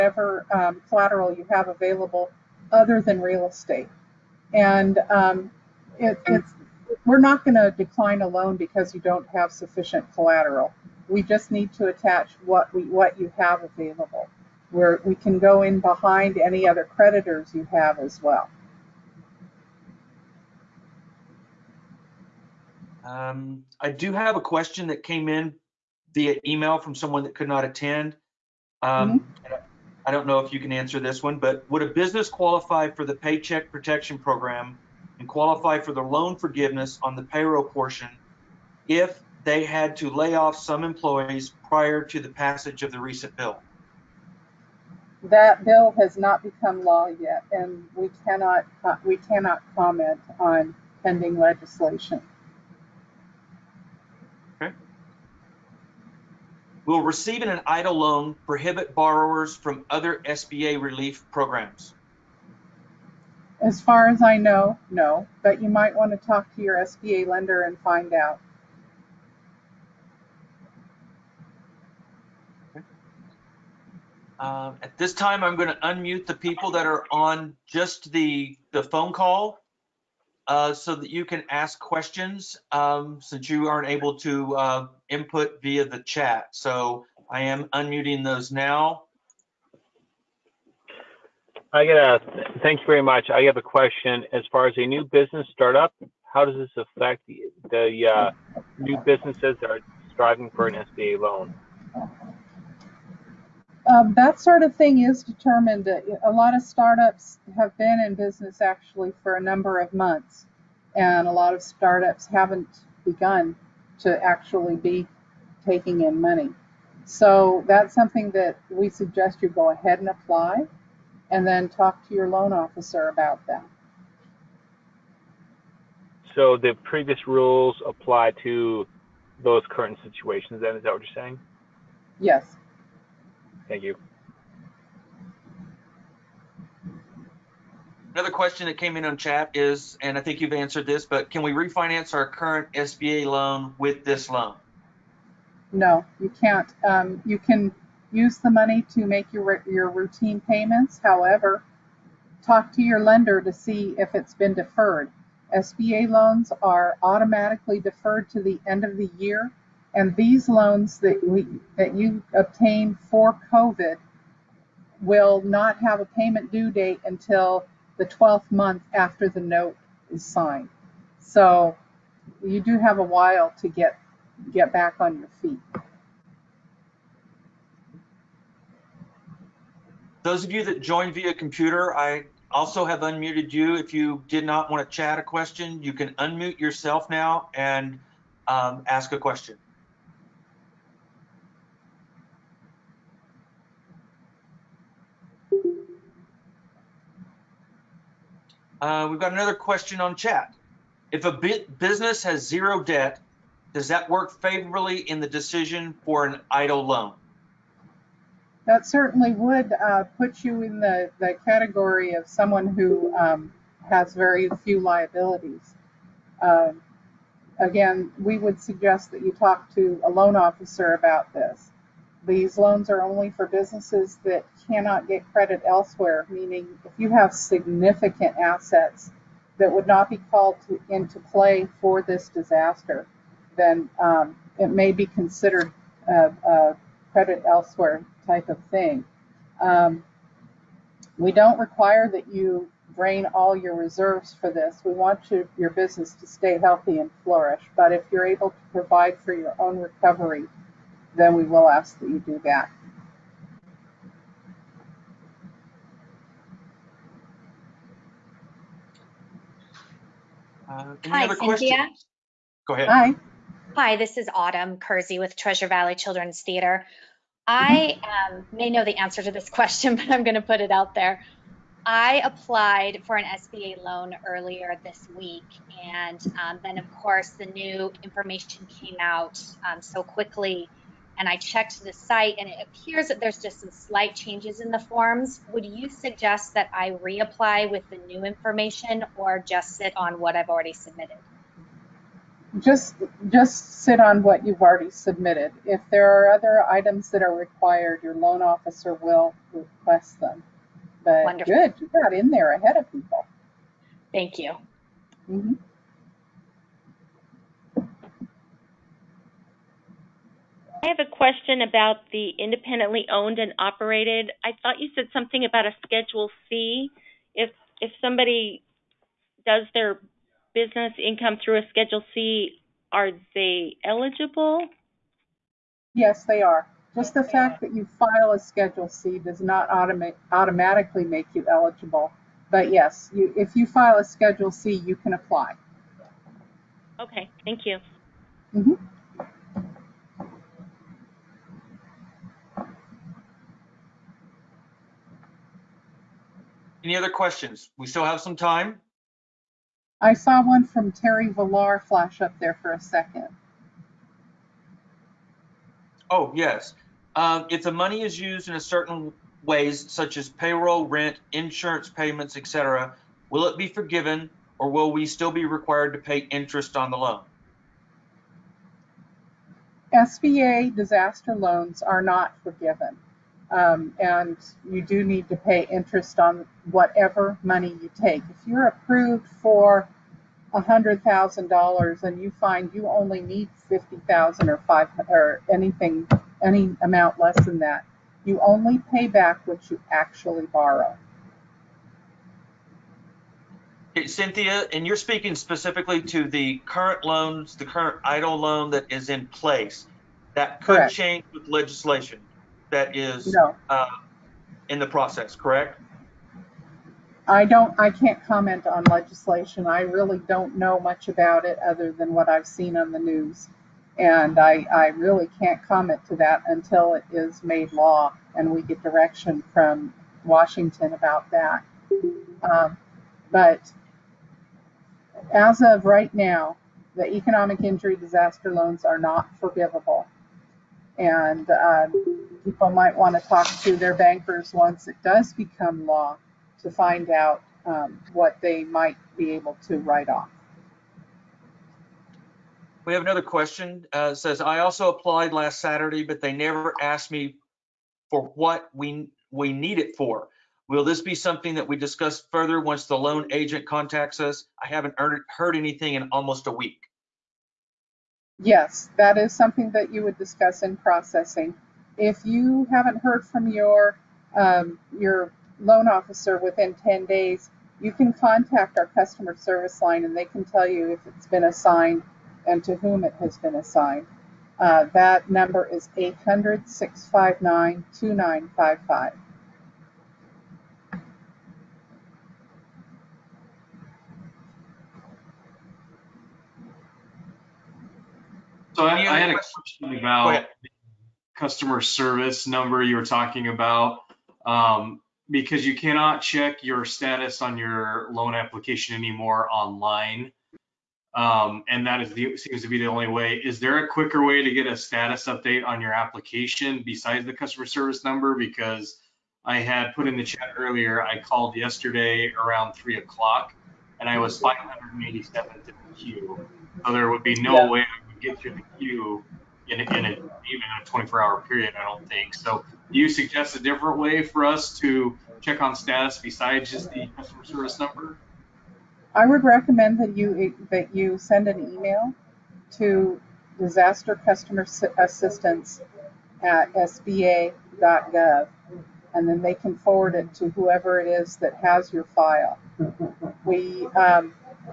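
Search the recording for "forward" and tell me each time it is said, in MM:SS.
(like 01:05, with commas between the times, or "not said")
08:59.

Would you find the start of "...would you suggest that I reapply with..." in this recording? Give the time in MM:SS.
04:45.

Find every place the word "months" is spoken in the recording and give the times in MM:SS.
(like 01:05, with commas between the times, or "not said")
01:49, 02:48.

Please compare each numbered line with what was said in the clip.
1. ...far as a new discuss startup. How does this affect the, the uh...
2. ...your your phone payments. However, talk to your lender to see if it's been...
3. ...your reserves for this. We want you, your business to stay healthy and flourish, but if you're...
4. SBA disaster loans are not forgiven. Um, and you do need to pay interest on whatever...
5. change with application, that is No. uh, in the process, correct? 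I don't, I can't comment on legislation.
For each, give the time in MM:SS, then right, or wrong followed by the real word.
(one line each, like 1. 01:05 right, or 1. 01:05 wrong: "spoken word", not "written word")
1. 01:34 wrong: "business", not "discuss"
2. 02:29 wrong: "routine", not "phone"
3. 04:03 right
4. 06:09 right
5. 06:40 wrong: "legislation", not "application".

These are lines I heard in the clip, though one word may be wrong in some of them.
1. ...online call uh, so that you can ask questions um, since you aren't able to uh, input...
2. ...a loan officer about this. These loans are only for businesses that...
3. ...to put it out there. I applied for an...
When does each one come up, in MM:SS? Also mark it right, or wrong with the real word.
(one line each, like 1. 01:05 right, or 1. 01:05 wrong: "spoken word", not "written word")
1. 01:18 wrong: "phone", not "online"
2. 03:40 right
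3. 04:30 right.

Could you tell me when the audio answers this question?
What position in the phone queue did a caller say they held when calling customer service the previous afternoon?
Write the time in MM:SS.
08:34.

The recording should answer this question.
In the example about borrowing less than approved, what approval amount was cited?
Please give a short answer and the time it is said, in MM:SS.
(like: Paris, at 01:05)
$100,000, at 06:20.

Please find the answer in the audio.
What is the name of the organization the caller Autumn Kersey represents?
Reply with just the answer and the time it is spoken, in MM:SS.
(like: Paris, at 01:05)
Treasure Valley Children's Theater, at 04:25.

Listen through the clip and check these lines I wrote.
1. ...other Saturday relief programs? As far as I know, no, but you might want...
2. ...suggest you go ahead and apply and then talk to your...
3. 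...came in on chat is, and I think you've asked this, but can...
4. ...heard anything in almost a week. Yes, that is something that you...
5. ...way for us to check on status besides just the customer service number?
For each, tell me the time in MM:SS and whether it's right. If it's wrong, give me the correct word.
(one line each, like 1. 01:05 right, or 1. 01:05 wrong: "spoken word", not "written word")
1. 00:59 wrong: "SBA", not "Saturday"
2. 01:58 right
3. 02:18 wrong: "answered", not "asked"
4. 07:35 right
5. 08:43 right.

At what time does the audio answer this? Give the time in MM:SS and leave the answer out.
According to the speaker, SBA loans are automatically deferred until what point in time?
02:38.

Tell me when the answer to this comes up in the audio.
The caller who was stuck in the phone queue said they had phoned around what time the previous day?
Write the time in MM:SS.
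08:32.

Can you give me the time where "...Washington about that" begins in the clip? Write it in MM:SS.
07:00.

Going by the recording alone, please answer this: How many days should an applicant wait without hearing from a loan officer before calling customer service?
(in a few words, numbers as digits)
10.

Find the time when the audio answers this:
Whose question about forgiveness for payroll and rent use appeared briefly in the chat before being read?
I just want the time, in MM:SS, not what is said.
05:50.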